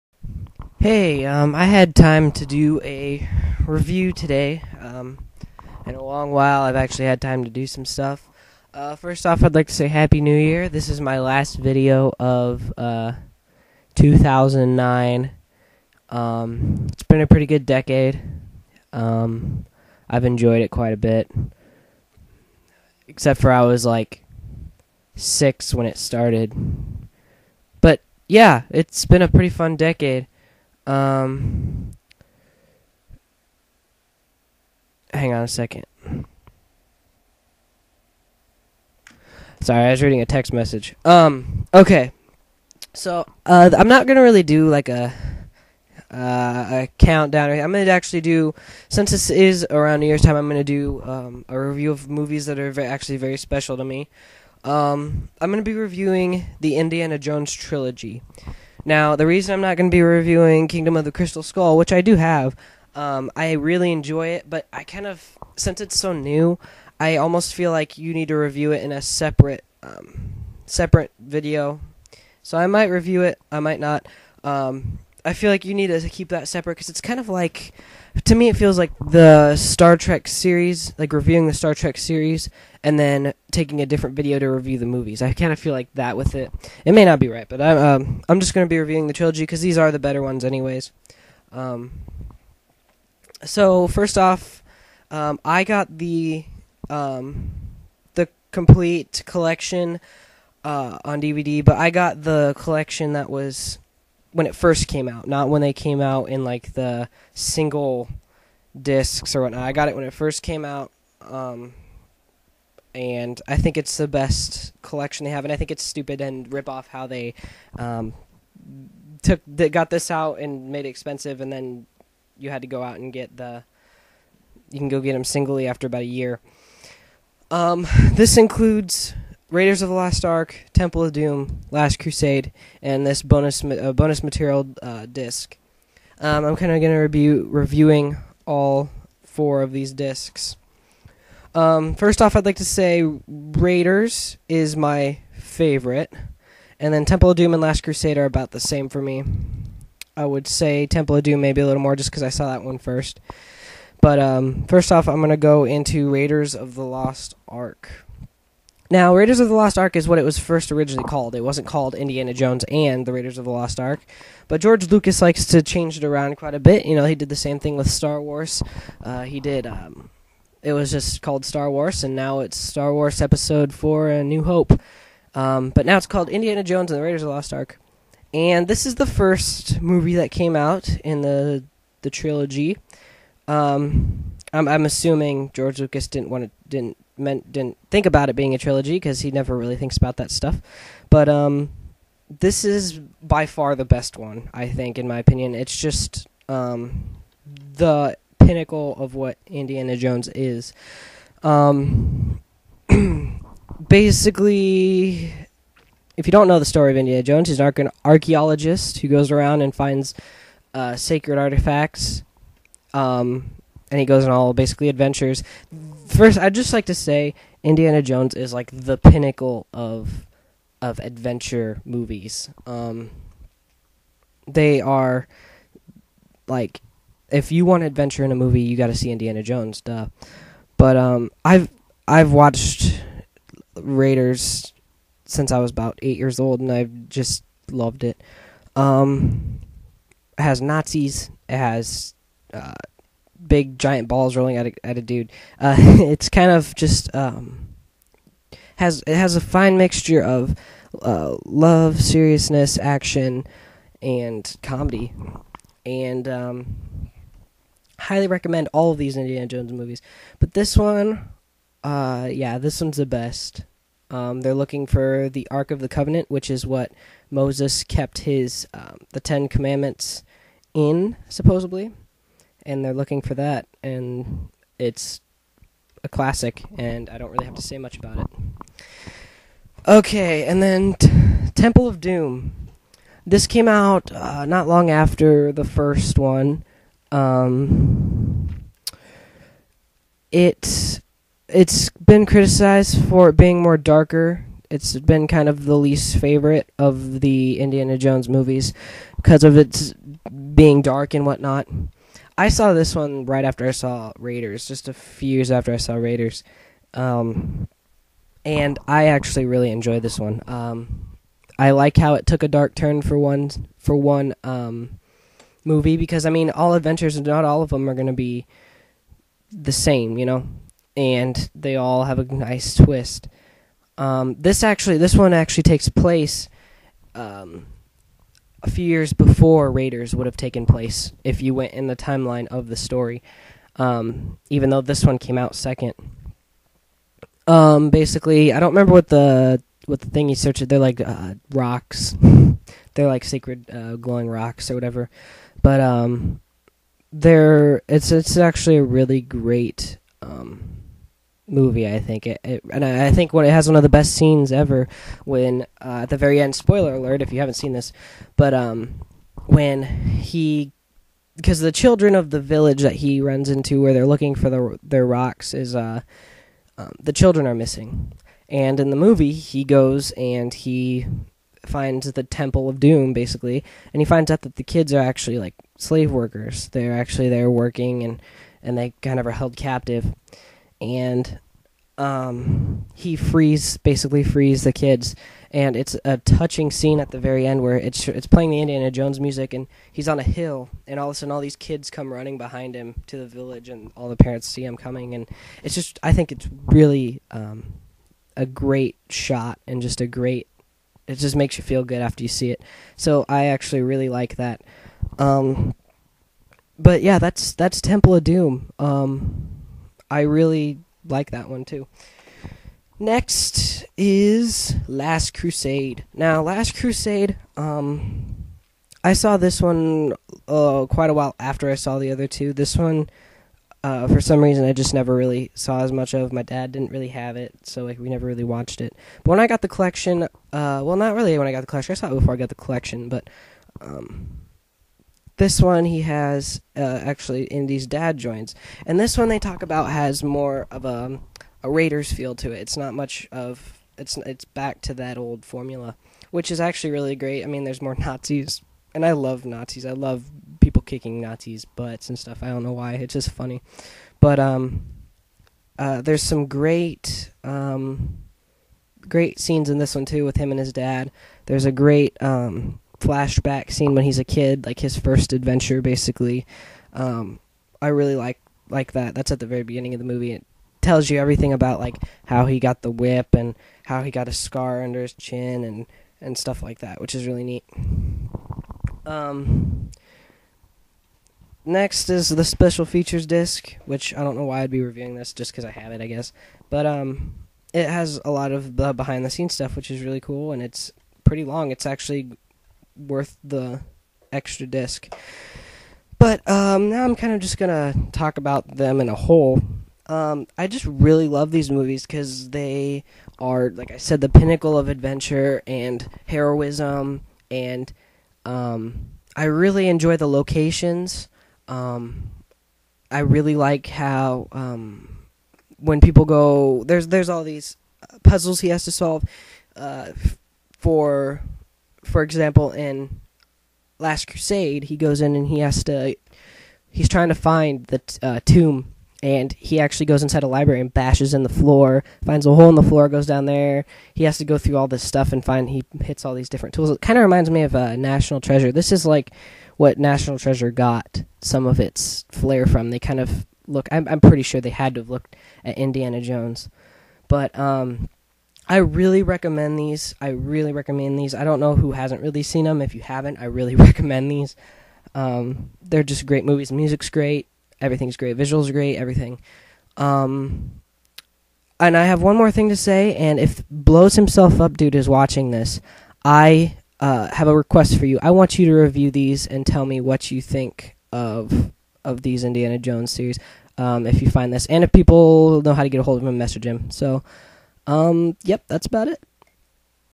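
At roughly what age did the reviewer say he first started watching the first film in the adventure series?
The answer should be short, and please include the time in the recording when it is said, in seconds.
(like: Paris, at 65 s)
8, at 236 s.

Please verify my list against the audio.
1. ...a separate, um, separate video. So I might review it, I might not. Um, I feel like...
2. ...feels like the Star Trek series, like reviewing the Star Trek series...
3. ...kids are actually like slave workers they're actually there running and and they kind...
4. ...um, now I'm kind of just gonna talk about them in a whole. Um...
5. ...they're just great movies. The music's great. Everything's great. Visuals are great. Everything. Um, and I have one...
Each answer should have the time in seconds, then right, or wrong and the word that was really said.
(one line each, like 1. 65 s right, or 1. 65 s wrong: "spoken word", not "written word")
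1. 68 s right
2. 78 s right
3. 374 s wrong: "working", not "running"
4. 496 s right
5. 555 s right.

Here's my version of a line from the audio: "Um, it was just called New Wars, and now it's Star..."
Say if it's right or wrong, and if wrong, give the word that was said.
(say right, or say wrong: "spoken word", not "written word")
wrong: "Star", not "New".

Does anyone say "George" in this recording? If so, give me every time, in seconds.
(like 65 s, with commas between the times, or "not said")
164 s, 185 s.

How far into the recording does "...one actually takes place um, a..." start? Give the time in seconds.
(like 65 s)
325 s.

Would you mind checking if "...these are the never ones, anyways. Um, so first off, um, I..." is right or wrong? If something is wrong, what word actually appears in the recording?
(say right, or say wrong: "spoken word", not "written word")
wrong: "better", not "never".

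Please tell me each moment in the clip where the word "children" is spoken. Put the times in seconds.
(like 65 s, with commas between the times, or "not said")
361 s, 367 s.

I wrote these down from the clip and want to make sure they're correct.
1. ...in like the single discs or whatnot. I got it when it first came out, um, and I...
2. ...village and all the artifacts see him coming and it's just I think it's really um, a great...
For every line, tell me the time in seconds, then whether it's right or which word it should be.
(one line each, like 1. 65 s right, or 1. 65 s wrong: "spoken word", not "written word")
1. 106 s right
2. 393 s wrong: "parents", not "artifacts".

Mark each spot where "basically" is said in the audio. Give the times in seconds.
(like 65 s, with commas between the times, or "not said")
203 s, 214 s, 337 s, 373 s, 383 s, 465 s.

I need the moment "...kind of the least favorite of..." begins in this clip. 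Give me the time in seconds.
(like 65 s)
295 s.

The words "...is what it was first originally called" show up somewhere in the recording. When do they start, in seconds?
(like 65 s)
159 s.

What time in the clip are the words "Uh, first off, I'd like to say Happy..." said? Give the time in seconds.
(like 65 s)
8 s.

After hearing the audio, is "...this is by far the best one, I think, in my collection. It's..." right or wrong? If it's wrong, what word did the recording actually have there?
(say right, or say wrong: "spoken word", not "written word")
wrong: "opinion", not "collection".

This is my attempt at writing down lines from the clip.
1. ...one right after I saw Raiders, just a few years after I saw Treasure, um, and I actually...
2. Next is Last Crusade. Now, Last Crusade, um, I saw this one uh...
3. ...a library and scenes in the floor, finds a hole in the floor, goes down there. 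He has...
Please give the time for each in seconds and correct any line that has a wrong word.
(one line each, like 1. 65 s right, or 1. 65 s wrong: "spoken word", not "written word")
1. 302 s wrong: "Raiders", not "Treasure"
2. 412 s right
3. 530 s wrong: "bashes", not "scenes".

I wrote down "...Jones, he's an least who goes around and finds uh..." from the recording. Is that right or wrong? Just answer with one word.
wrong.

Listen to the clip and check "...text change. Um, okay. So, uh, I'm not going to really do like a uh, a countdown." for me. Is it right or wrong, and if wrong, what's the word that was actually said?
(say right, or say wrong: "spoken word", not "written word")
wrong: "message", not "change".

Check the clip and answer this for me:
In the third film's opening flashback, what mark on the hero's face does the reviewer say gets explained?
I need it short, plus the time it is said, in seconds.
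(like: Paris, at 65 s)
scar under his chin, at 474 s.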